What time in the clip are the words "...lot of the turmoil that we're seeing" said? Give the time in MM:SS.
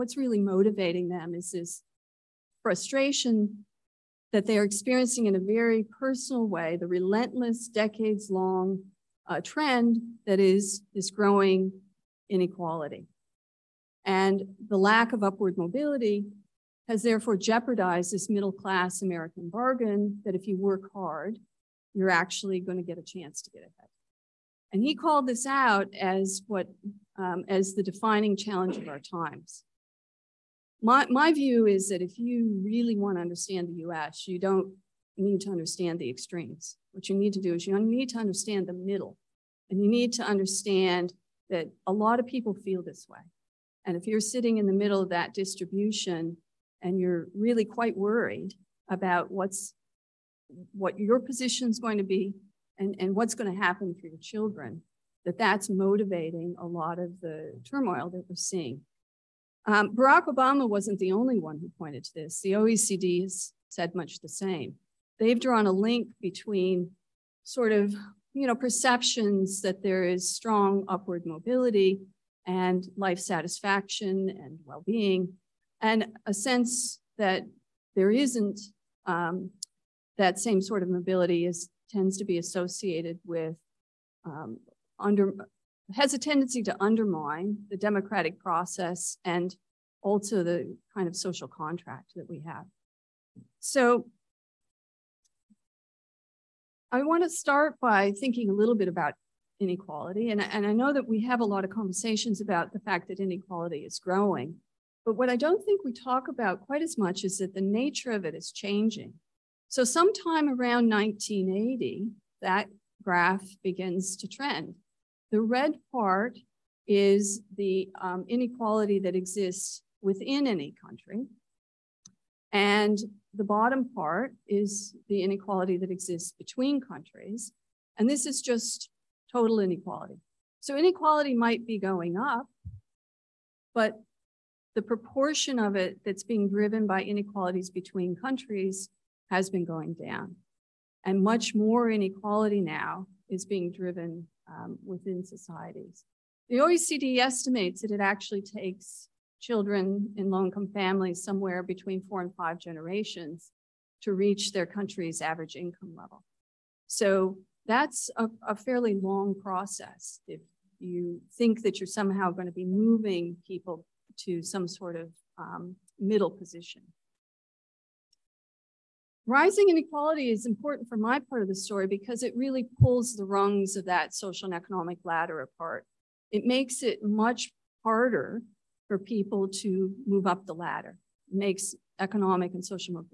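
00:56.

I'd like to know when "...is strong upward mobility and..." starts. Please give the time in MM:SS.
01:10.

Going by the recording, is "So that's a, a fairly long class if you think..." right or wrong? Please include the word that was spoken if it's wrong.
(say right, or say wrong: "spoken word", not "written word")
wrong: "process", not "class".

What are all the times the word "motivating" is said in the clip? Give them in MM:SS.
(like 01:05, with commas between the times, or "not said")
00:00, 00:55.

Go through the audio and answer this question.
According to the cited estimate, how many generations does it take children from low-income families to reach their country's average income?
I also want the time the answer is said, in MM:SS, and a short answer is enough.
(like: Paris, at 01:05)
4 to 5, at 02:32.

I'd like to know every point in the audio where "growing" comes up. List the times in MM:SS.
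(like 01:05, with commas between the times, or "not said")
00:11, 01:43.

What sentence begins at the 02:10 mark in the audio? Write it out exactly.
So inequality might be going up, but the proportion of it that's being driven by inequalities between countries has been going down.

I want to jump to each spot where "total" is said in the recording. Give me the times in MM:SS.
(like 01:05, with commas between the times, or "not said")
02:09.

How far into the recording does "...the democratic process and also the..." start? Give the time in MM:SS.
01:27.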